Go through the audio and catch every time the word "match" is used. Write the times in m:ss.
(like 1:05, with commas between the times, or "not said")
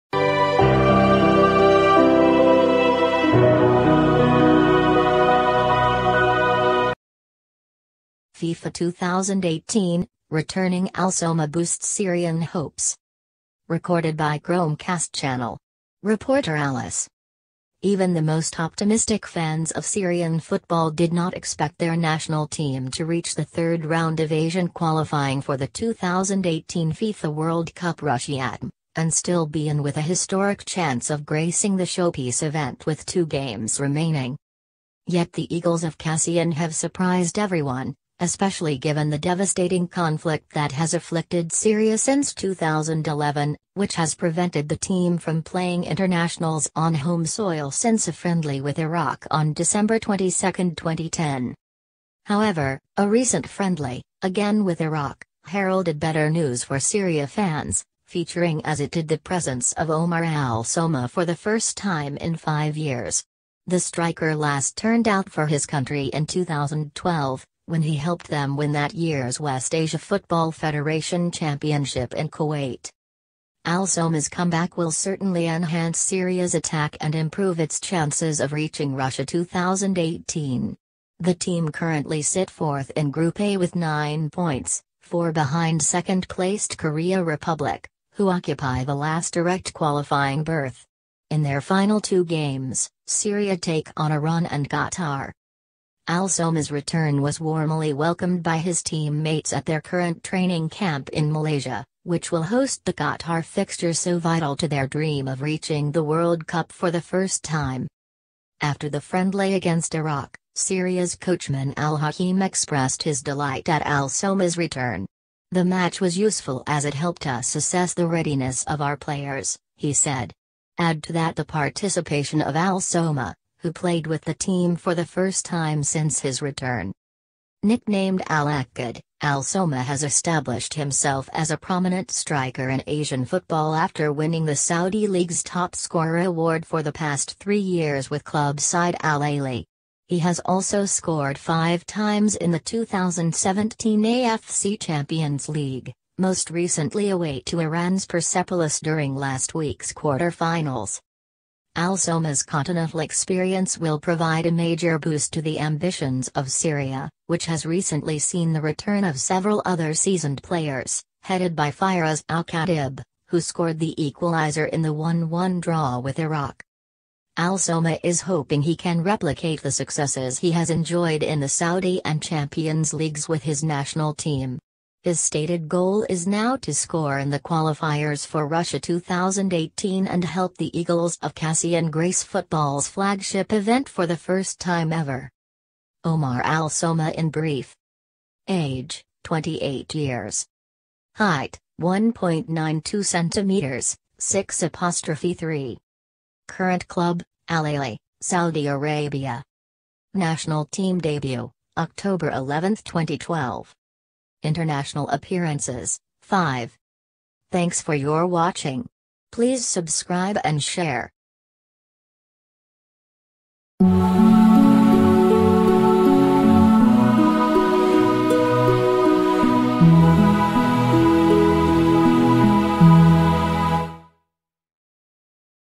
1:55.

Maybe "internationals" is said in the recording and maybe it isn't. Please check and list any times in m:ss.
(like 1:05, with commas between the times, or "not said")
0:45, 3:24.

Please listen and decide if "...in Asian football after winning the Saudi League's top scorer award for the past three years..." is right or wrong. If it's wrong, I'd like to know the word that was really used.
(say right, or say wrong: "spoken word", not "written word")
right.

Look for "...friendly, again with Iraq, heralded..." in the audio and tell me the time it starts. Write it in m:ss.
0:53.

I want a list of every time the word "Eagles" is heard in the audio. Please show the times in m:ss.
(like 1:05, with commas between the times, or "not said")
0:35, 3:00.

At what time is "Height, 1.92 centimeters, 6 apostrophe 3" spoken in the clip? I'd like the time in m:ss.
3:11.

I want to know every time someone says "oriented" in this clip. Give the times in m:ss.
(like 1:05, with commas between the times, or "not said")
not said.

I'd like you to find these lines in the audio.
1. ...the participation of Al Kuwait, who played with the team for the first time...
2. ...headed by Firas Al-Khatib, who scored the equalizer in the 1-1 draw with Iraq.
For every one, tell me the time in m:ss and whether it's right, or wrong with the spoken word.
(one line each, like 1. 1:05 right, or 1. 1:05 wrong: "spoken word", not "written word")
1. 2:01 wrong: "Soma", not "Kuwait"
2. 2:41 right.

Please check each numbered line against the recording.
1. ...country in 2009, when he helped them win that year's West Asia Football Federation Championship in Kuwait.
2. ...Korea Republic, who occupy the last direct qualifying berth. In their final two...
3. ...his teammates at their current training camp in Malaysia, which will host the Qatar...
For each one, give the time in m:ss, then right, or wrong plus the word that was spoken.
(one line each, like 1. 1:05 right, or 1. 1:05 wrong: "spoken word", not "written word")
1. 1:05 wrong: "2012", not "2009"
2. 1:26 right
3. 1:38 right.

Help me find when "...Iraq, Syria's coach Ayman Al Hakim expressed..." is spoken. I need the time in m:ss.
1:49.